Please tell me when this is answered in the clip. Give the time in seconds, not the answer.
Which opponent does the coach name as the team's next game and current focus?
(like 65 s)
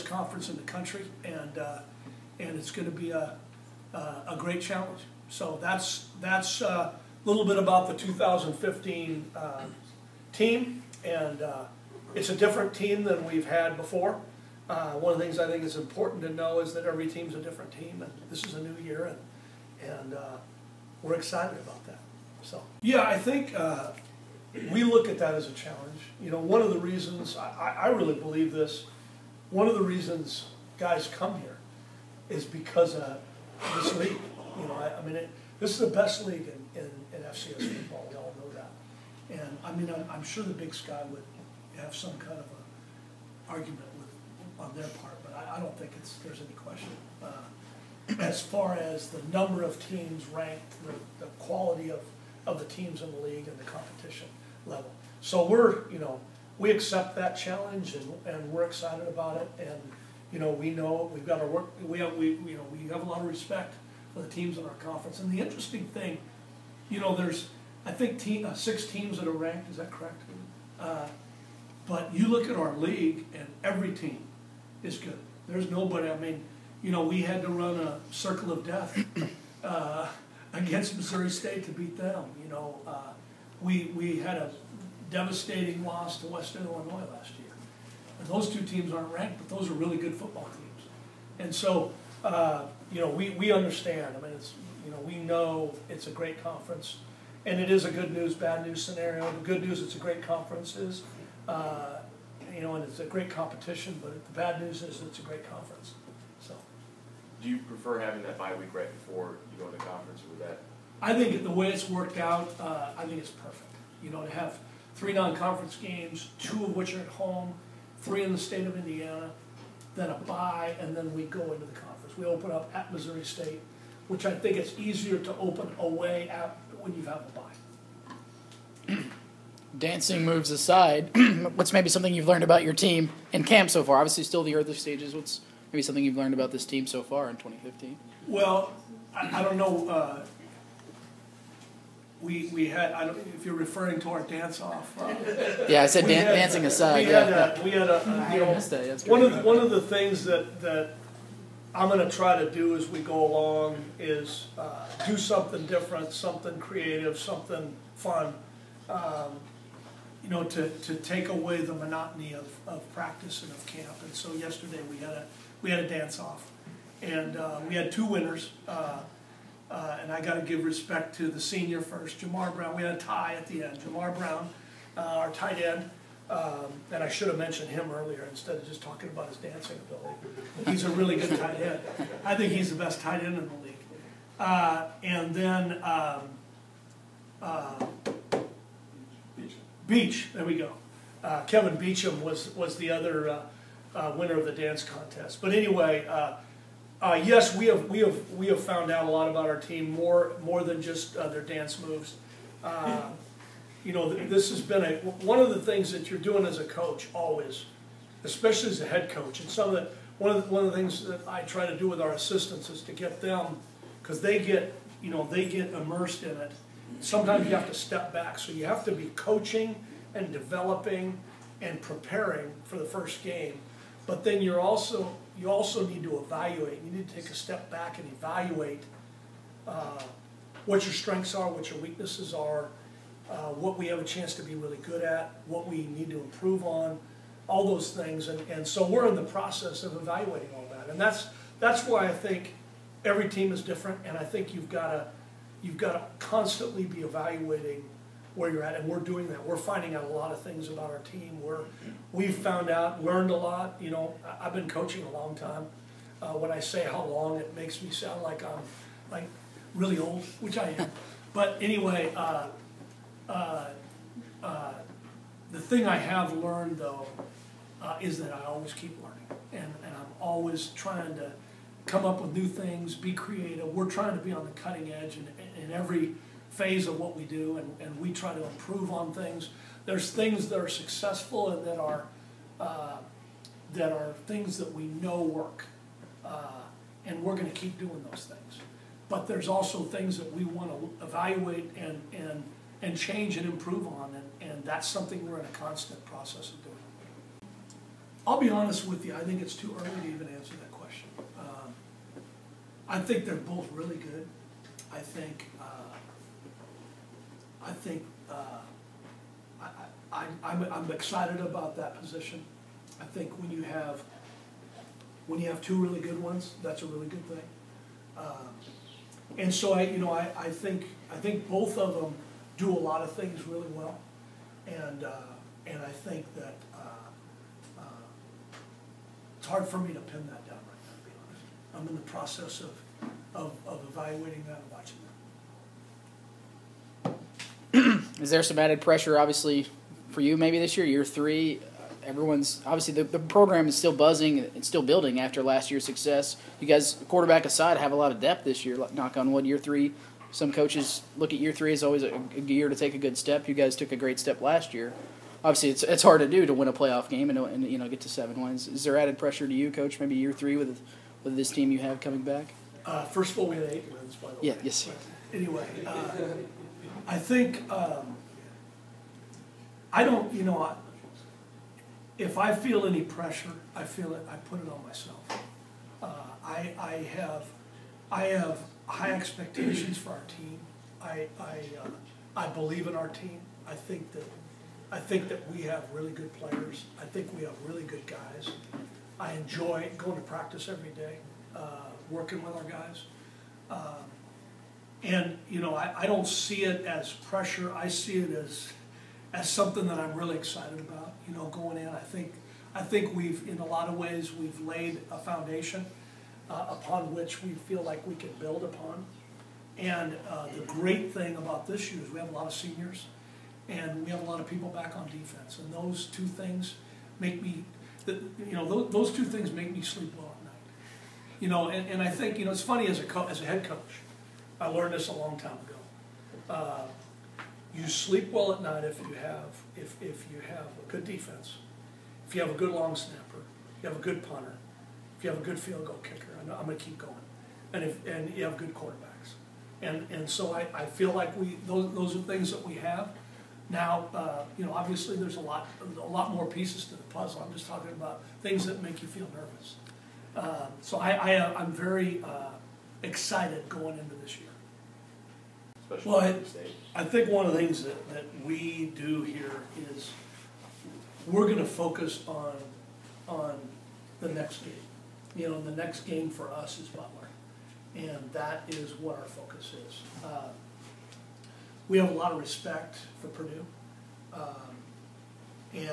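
466 s.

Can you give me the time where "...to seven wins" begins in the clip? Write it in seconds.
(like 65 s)
358 s.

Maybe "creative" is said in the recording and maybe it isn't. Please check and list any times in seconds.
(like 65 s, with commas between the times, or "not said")
156 s, 273 s.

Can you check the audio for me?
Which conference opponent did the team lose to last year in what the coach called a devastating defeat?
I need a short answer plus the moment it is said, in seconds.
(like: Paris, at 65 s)
Western Illinois, at 86 s.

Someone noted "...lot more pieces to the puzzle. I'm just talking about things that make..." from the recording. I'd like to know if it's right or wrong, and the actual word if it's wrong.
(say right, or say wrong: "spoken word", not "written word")
right.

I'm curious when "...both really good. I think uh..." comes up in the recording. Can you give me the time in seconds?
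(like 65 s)
303 s.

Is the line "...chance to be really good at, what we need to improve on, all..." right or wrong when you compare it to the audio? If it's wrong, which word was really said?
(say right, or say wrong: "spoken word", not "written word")
right.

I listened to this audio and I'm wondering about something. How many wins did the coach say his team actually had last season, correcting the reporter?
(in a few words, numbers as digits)
8.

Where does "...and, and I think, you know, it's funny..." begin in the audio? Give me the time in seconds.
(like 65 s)
421 s.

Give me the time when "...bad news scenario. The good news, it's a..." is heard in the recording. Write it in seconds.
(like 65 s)
98 s.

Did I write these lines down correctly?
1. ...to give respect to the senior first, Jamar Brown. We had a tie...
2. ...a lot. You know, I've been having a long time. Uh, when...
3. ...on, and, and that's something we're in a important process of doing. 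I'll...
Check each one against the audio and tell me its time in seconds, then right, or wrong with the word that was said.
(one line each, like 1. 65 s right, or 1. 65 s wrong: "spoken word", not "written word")
1. 170 s right
2. 253 s wrong: "coaching", not "having"
3. 293 s wrong: "constant", not "important".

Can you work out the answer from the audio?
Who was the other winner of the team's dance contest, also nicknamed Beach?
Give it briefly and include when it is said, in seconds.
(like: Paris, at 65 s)
Kevin Beecham, at 191 s.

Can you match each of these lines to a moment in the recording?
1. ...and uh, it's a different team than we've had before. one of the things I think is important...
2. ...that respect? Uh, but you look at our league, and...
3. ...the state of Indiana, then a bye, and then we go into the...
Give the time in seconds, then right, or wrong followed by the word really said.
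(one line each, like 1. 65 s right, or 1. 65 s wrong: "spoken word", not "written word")
1. 11 s right
2. 69 s wrong: "correct", not "respect"
3. 118 s right.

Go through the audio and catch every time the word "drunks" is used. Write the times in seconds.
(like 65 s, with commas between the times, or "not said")
not said.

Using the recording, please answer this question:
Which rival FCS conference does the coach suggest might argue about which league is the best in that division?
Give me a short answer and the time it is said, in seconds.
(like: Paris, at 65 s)
Big Sky, at 40 s.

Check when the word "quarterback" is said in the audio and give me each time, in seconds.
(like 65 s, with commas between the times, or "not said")
347 s, 438 s.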